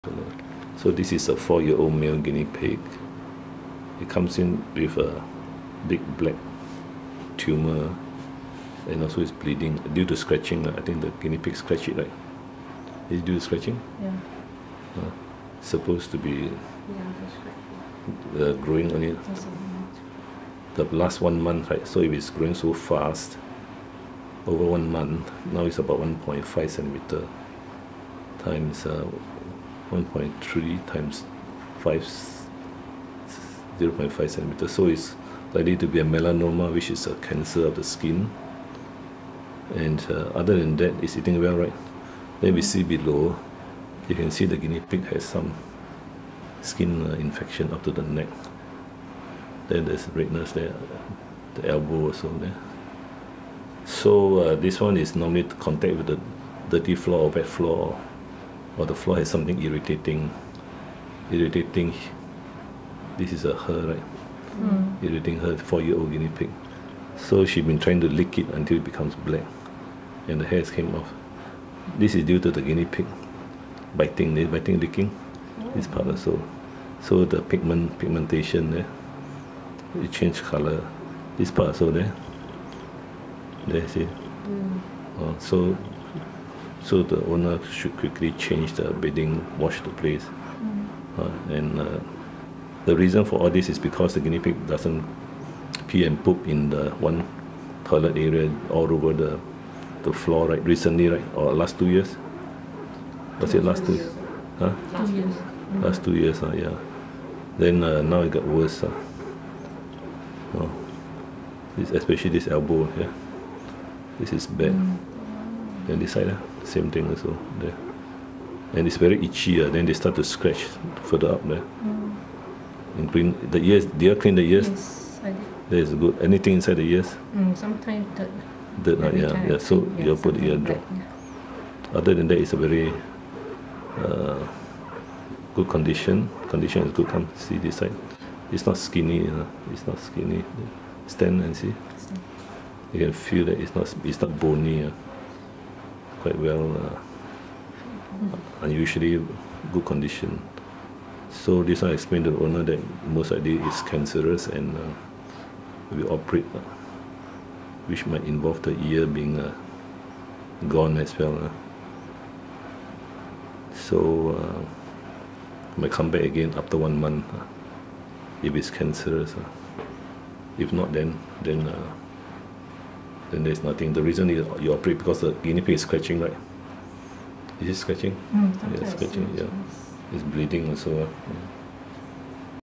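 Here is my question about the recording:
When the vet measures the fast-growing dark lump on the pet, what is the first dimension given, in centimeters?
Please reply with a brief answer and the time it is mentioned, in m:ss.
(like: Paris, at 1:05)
1.5 centimeters, at 0:25.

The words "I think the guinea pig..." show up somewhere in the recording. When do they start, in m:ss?
0:10.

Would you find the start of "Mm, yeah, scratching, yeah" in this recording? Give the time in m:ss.
2:58.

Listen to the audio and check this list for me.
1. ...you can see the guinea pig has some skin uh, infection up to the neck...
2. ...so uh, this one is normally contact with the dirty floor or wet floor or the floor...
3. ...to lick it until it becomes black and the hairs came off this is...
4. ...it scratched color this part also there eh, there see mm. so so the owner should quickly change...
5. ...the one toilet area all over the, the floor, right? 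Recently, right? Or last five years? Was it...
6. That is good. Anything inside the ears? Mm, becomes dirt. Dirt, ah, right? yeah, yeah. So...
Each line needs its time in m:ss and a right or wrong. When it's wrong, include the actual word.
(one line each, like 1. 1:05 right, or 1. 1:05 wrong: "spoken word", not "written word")
1. 0:44 right
2. 0:53 right
3. 1:08 right
4. 1:20 wrong: "changed", not "scratched"
5. 1:36 wrong: "two", not "five"
6. 2:05 wrong: "sometimes", not "becomes".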